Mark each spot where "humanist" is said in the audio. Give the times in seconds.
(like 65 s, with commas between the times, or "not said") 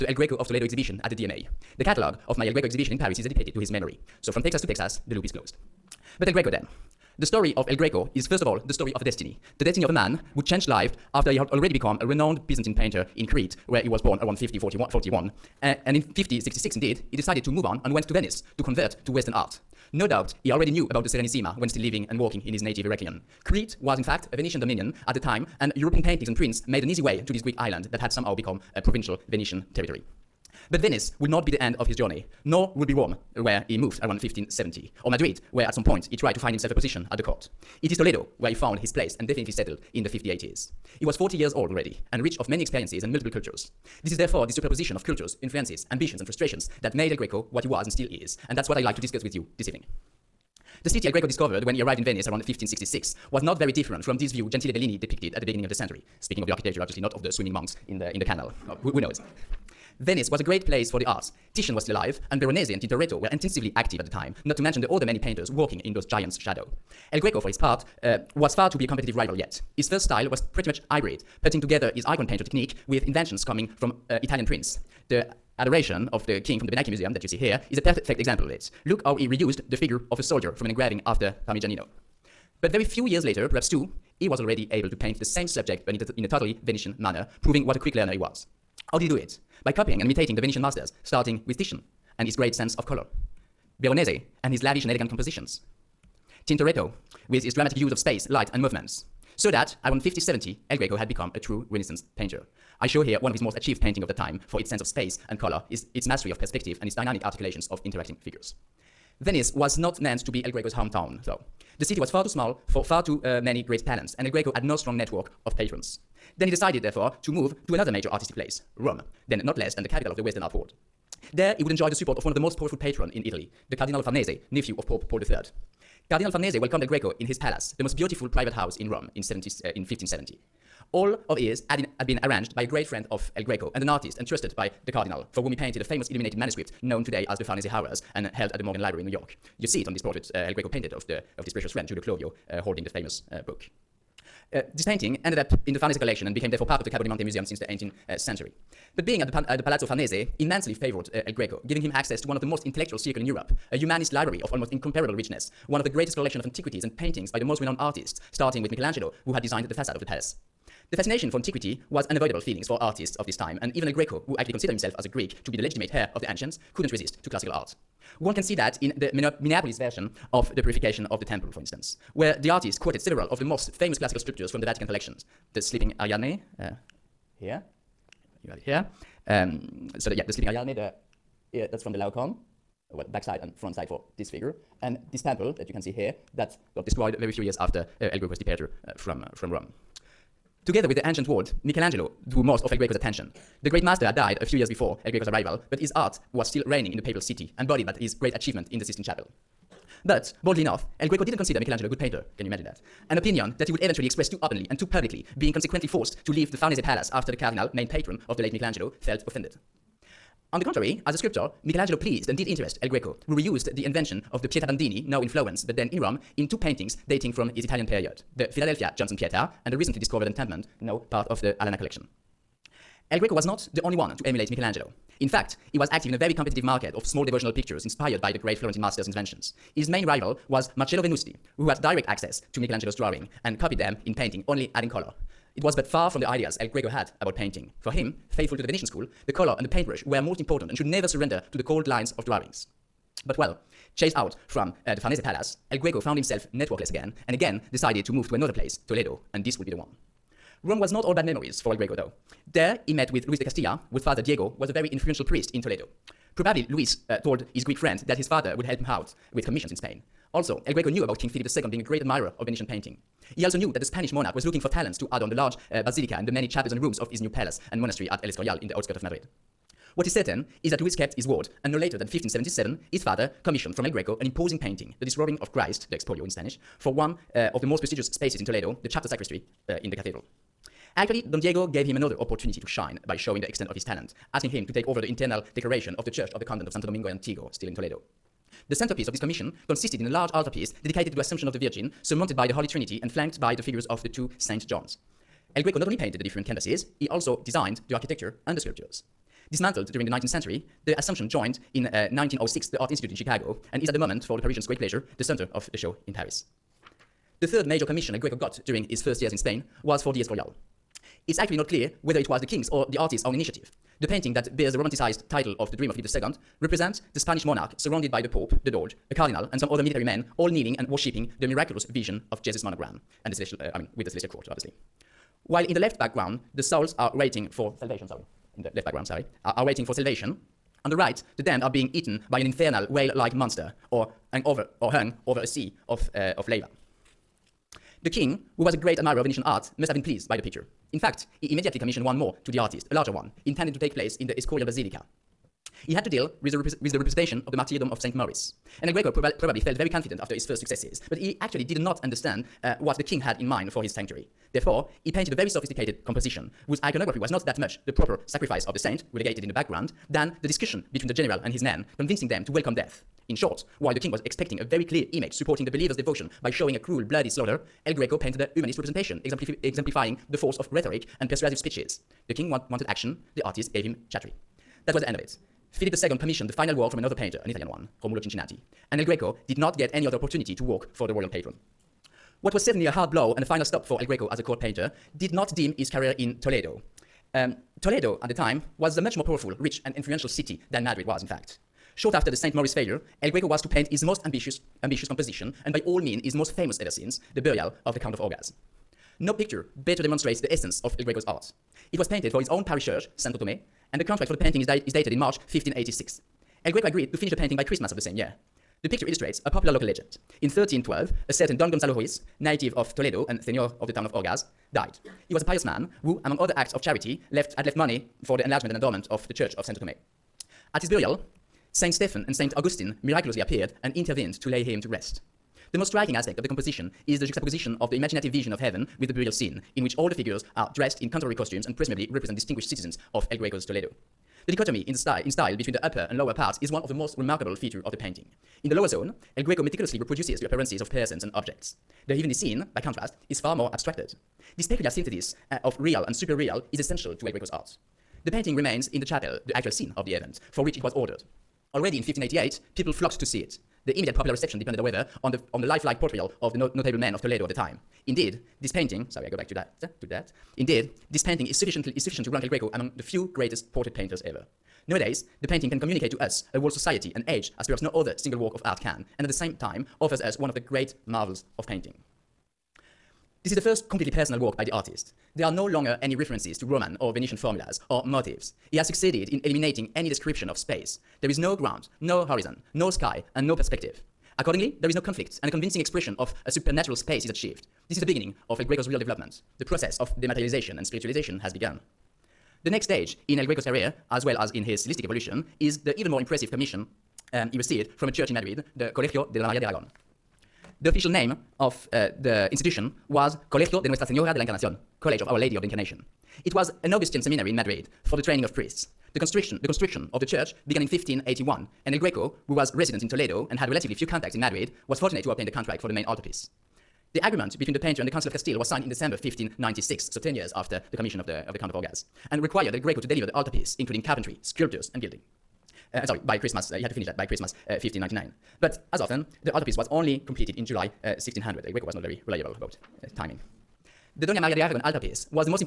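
153 s, 368 s.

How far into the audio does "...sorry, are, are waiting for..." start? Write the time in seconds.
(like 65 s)
329 s.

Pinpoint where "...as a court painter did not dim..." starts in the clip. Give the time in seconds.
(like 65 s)
384 s.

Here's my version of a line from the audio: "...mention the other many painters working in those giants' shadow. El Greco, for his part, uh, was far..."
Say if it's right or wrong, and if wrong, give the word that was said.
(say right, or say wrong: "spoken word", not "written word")
right.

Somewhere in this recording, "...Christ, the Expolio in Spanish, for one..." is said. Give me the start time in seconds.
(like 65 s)
275 s.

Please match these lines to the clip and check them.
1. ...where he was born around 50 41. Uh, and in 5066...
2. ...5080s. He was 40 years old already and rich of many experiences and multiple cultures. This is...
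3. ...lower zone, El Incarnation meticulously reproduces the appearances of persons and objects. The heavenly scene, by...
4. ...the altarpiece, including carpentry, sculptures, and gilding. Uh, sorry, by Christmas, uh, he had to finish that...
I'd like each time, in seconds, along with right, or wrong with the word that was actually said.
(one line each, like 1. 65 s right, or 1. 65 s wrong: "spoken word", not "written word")
1. 13 s right
2. 40 s right
3. 438 s wrong: "Greco", not "Incarnation"
4. 523 s right.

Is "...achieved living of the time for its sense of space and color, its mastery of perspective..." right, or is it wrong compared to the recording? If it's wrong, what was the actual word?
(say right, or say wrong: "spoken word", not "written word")
wrong: "painting", not "living".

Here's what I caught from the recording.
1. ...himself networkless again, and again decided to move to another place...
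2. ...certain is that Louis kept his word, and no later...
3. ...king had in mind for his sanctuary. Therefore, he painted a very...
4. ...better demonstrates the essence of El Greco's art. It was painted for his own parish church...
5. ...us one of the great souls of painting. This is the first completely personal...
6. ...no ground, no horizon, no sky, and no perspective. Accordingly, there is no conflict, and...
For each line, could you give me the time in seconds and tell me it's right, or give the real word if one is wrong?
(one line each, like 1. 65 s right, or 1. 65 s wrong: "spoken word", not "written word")
1. 246 s right
2. 270 s right
3. 353 s right
4. 399 s right
5. 470 s wrong: "marvels", not "souls"
6. 481 s right.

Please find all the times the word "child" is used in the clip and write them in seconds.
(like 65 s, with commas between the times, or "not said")
not said.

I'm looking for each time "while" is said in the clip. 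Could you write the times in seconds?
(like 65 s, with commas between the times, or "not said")
325 s, 363 s.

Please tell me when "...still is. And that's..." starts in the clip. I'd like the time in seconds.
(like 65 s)
47 s.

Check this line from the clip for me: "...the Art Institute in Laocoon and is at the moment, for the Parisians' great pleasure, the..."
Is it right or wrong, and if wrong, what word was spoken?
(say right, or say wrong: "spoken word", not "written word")
wrong: "Chicago", not "Laocoon".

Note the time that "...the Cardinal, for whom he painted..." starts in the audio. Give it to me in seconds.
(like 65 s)
134 s.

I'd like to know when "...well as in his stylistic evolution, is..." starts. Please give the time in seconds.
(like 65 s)
494 s.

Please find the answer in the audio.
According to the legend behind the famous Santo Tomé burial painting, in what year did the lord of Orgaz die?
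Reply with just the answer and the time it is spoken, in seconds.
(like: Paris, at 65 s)
1312, at 410 s.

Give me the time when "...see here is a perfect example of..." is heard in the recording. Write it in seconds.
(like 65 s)
77 s.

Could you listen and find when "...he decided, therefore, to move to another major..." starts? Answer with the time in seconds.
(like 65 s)
116 s.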